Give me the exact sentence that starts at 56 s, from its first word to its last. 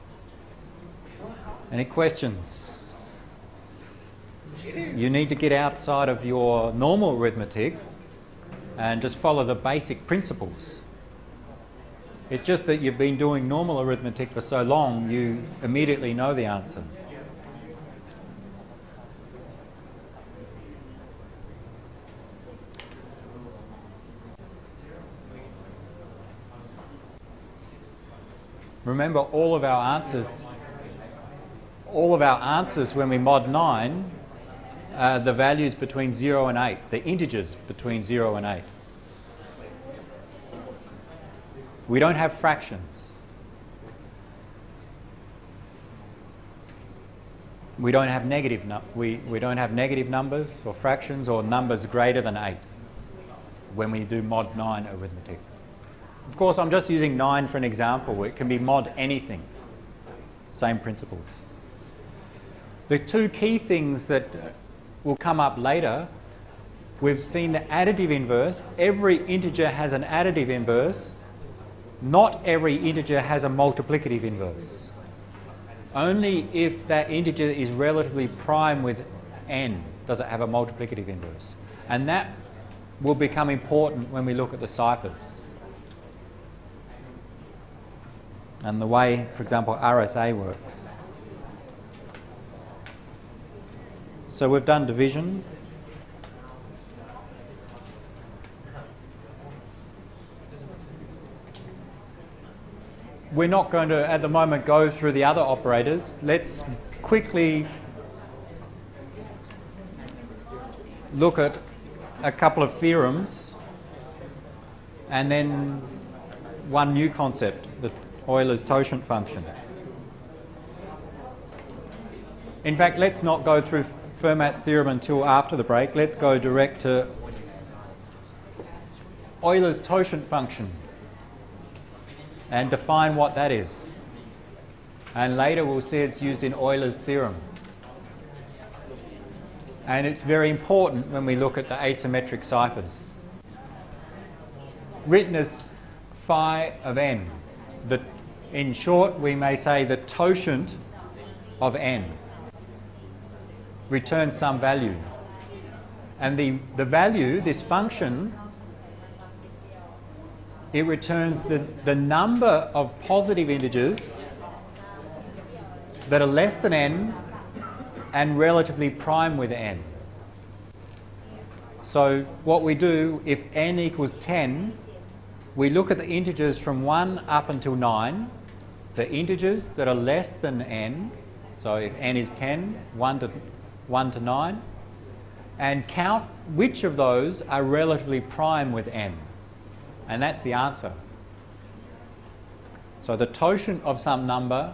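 Of course, I'm just using 9 for an example.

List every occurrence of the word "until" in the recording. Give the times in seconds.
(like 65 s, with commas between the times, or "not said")
124 s, 177 s.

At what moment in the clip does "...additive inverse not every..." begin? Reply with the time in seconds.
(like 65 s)
70 s.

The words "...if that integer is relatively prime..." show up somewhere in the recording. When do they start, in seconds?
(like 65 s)
76 s.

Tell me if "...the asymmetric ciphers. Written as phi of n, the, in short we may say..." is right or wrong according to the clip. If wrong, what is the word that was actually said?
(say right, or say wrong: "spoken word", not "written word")
right.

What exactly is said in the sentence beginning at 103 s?
We're not going to, at the moment, go through the other operators.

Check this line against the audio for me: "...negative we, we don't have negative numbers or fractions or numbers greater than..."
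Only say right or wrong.
right.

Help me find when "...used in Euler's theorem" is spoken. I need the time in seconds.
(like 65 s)
136 s.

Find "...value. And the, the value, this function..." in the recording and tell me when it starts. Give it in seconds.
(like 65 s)
154 s.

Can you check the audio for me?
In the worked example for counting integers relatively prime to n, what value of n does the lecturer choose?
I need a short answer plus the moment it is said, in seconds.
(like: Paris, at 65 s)
10, at 173 s.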